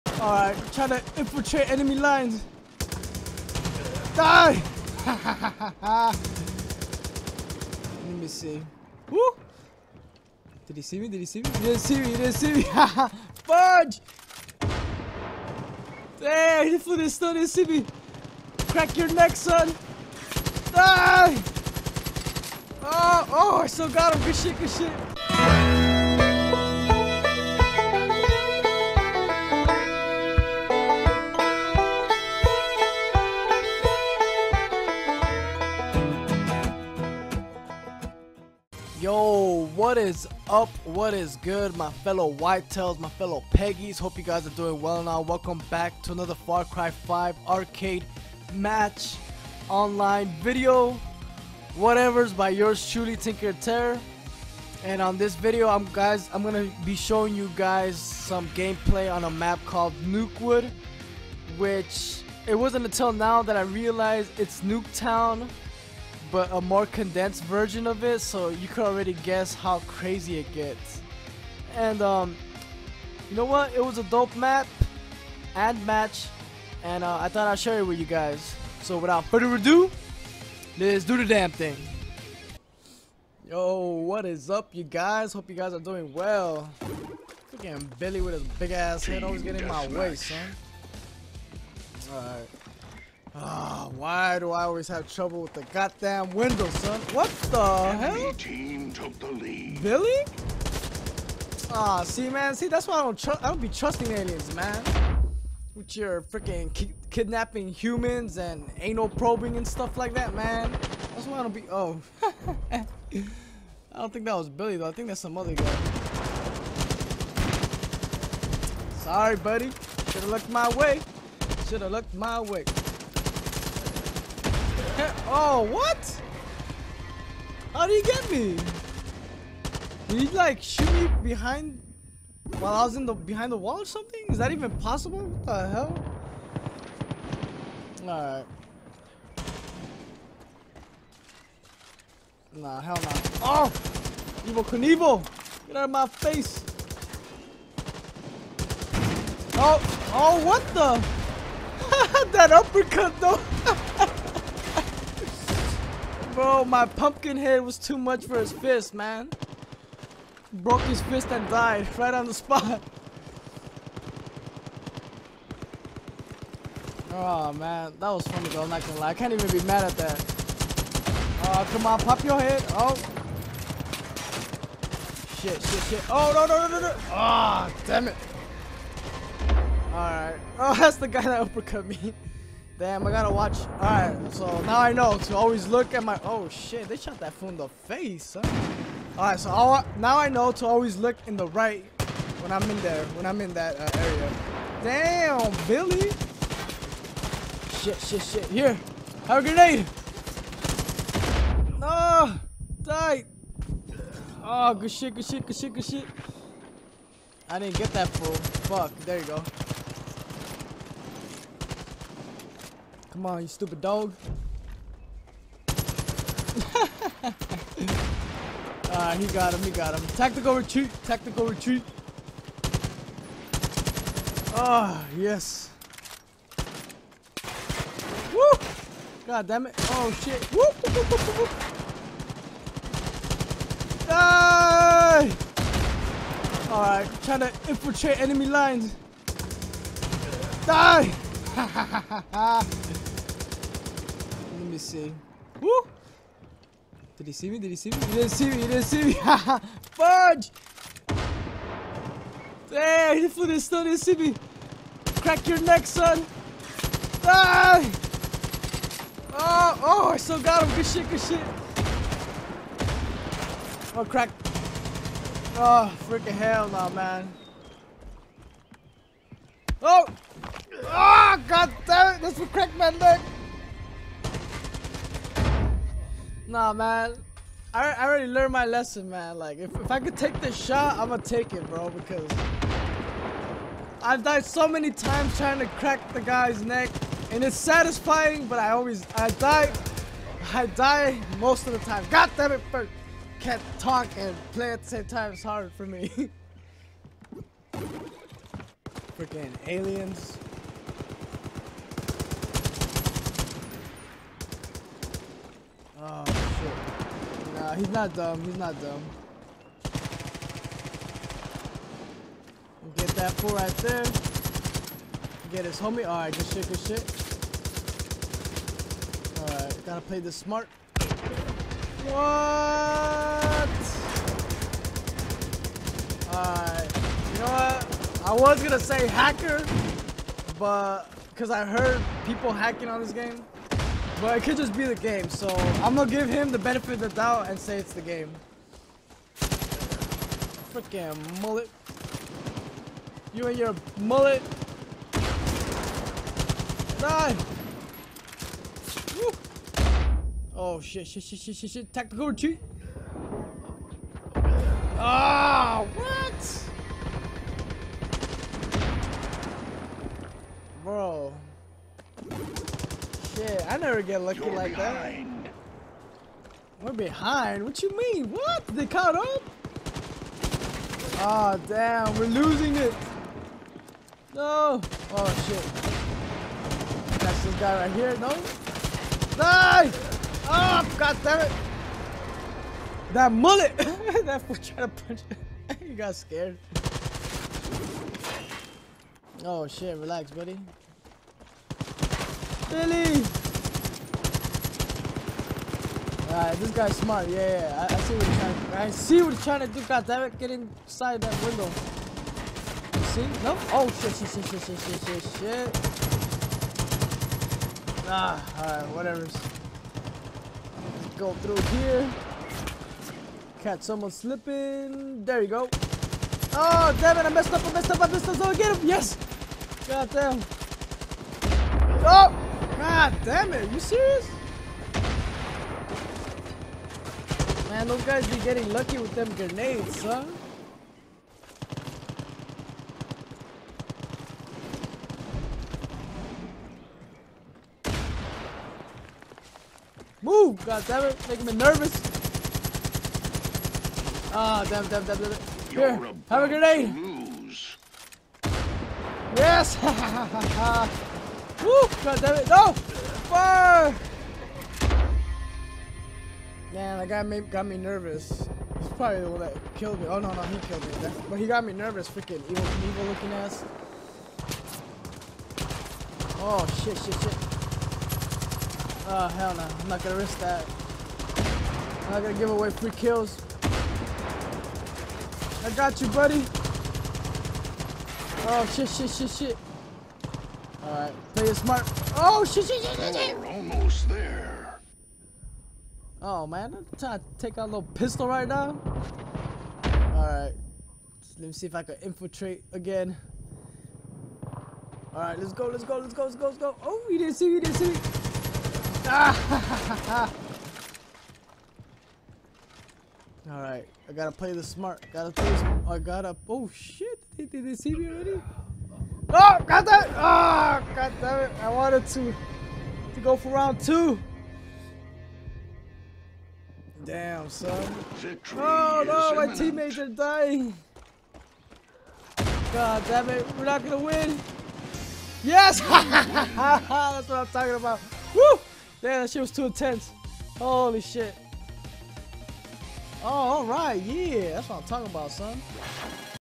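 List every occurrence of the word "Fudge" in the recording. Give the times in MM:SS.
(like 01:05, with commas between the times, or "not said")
00:13, 04:09.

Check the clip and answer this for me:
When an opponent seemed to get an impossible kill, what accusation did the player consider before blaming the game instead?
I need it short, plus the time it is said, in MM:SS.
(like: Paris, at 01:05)
hacker, at 05:29.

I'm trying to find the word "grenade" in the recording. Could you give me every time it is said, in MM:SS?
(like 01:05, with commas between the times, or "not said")
03:19, 07:09, 07:26.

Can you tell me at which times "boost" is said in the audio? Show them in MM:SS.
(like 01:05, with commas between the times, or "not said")
not said.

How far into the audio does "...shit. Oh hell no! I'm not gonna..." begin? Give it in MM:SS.
07:47.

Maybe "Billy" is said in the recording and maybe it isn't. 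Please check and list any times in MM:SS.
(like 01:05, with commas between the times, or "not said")
01:27, 01:39, 01:54, 03:15, 06:32.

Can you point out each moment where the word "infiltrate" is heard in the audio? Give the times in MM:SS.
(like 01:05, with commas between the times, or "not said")
00:01, 03:57, 08:12.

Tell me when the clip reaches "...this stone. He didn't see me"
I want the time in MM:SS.
00:16.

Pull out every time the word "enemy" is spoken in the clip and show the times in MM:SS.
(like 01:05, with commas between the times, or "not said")
00:01, 03:58.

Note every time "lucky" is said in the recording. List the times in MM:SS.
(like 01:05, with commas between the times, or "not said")
06:04, 07:08.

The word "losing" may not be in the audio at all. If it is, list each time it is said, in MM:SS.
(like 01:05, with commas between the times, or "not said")
06:12.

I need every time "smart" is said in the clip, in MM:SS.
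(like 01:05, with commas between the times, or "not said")
05:20, 06:36, 08:01, 08:24.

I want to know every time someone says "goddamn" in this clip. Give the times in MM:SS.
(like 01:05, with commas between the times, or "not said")
01:35.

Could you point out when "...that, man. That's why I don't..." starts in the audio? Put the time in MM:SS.
01:50.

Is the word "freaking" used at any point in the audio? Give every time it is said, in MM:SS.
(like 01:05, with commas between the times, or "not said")
01:27, 01:46, 04:26, 04:59, 05:39, 07:42.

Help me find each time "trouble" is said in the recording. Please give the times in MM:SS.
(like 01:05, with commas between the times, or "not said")
01:35.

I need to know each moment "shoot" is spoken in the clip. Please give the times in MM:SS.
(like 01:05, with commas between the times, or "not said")
02:10.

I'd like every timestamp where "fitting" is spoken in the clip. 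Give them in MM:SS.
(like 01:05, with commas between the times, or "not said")
not said.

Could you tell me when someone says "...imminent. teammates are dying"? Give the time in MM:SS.
08:39.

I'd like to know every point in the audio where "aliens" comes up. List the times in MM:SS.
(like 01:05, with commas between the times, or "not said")
01:44, 04:59.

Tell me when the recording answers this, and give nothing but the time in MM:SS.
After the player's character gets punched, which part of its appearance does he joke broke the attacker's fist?
02:36.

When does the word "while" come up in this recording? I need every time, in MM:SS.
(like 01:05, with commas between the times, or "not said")
02:12.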